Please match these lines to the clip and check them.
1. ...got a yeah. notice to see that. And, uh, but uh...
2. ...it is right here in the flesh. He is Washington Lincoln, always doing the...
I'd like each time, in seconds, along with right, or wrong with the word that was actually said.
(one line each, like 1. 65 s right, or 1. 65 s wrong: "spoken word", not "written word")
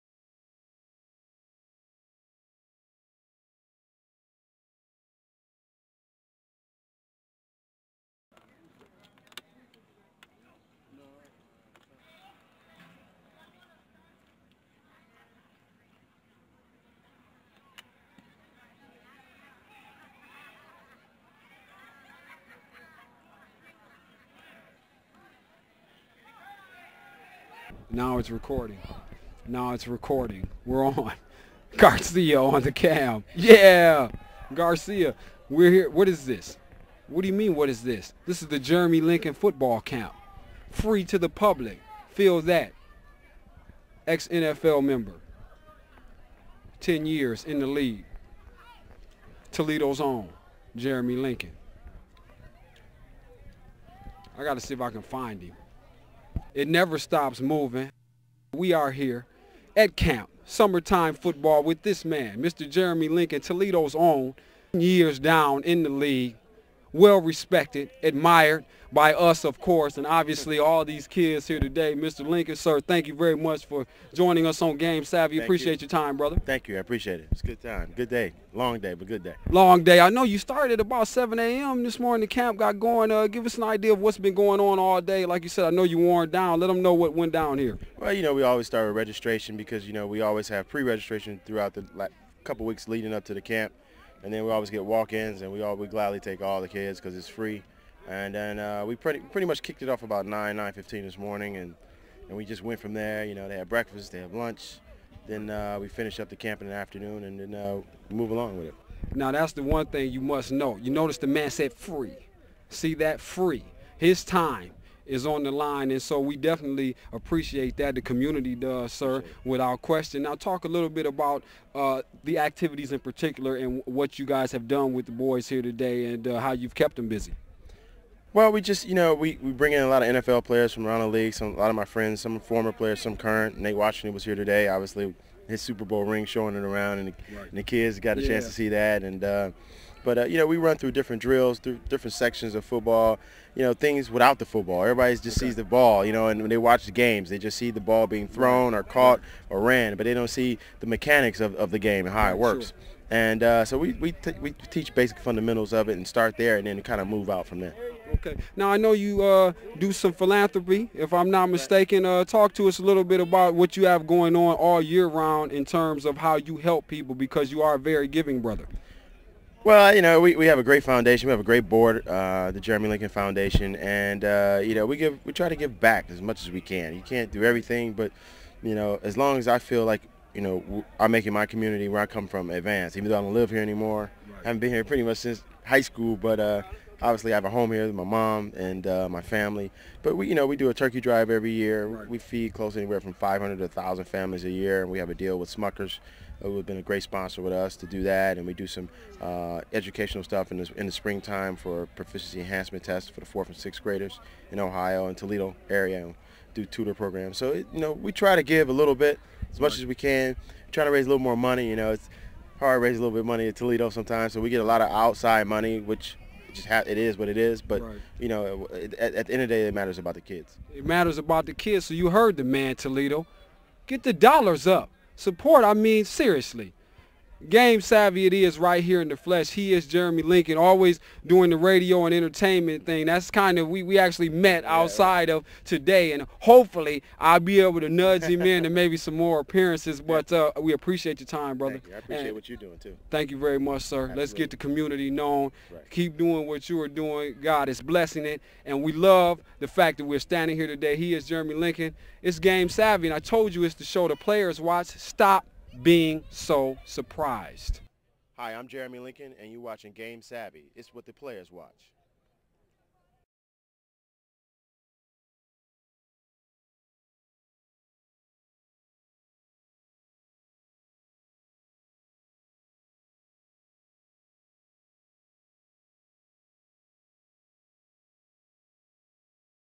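1. 137 s wrong: "chance", not "notice"
2. 228 s wrong: "Jeremy", not "Washington".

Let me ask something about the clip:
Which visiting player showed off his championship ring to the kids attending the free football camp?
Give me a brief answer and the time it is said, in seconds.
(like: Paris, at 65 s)
Nate Washington, at 133 s.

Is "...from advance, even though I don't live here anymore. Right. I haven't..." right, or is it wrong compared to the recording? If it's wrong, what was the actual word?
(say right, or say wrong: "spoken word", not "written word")
right.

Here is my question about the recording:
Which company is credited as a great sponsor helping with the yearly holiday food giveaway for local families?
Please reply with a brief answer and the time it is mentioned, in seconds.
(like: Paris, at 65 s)
Smuckers, at 195 s.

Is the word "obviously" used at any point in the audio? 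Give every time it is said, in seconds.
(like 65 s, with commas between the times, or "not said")
70 s, 134 s, 187 s.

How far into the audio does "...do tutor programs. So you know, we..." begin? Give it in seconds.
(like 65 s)
206 s.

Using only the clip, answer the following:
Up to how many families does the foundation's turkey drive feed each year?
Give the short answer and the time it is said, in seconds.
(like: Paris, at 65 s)
1,000, at 193 s.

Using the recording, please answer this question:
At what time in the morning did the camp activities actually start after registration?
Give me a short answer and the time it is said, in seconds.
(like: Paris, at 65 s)
9:15, at 100 s.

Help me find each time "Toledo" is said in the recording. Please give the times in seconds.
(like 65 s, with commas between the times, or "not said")
49 s, 63 s, 205 s, 213 s, 222 s.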